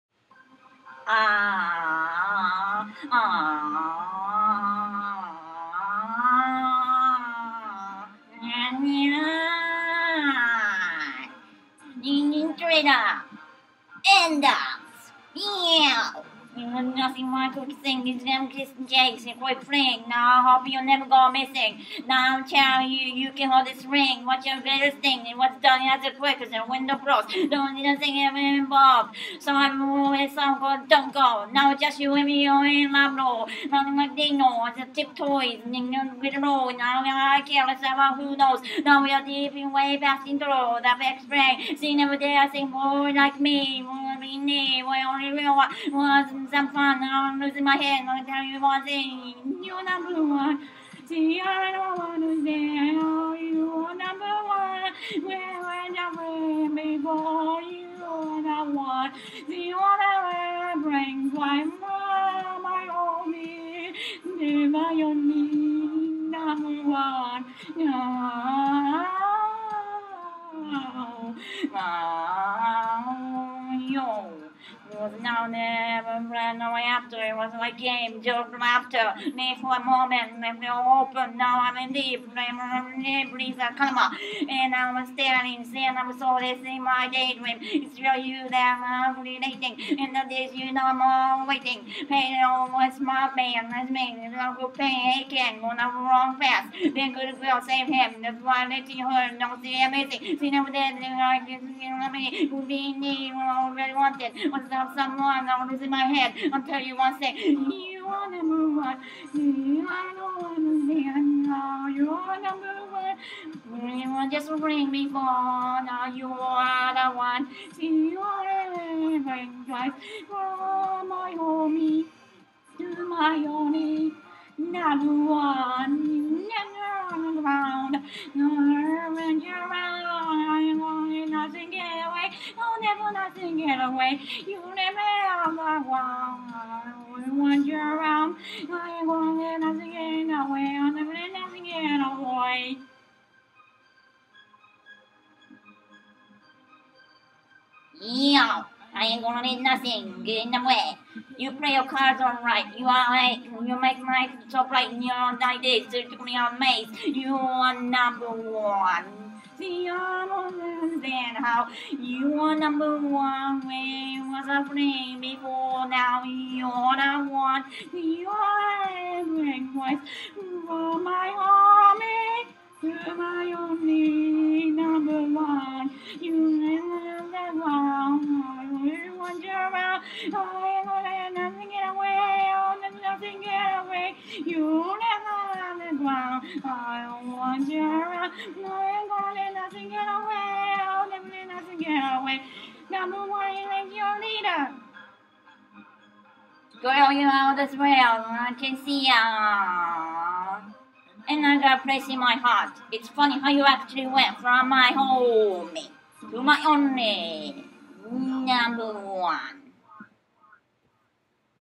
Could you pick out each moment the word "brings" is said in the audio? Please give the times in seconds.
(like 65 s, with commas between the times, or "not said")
60 s, 114 s.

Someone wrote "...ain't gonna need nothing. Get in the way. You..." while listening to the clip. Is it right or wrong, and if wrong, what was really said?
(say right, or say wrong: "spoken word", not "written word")
right.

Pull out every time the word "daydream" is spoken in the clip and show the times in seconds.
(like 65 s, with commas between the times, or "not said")
87 s.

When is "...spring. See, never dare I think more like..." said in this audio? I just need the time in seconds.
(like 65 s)
41 s.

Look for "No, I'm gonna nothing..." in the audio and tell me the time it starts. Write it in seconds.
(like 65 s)
188 s.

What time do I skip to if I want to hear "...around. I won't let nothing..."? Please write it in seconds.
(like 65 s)
137 s.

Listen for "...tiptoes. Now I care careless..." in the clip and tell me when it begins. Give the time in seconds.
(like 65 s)
34 s.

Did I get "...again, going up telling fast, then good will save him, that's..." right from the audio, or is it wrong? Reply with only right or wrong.
wrong.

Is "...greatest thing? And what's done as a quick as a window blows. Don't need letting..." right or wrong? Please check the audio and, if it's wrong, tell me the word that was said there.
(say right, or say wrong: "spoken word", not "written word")
wrong: "nothing", not "letting".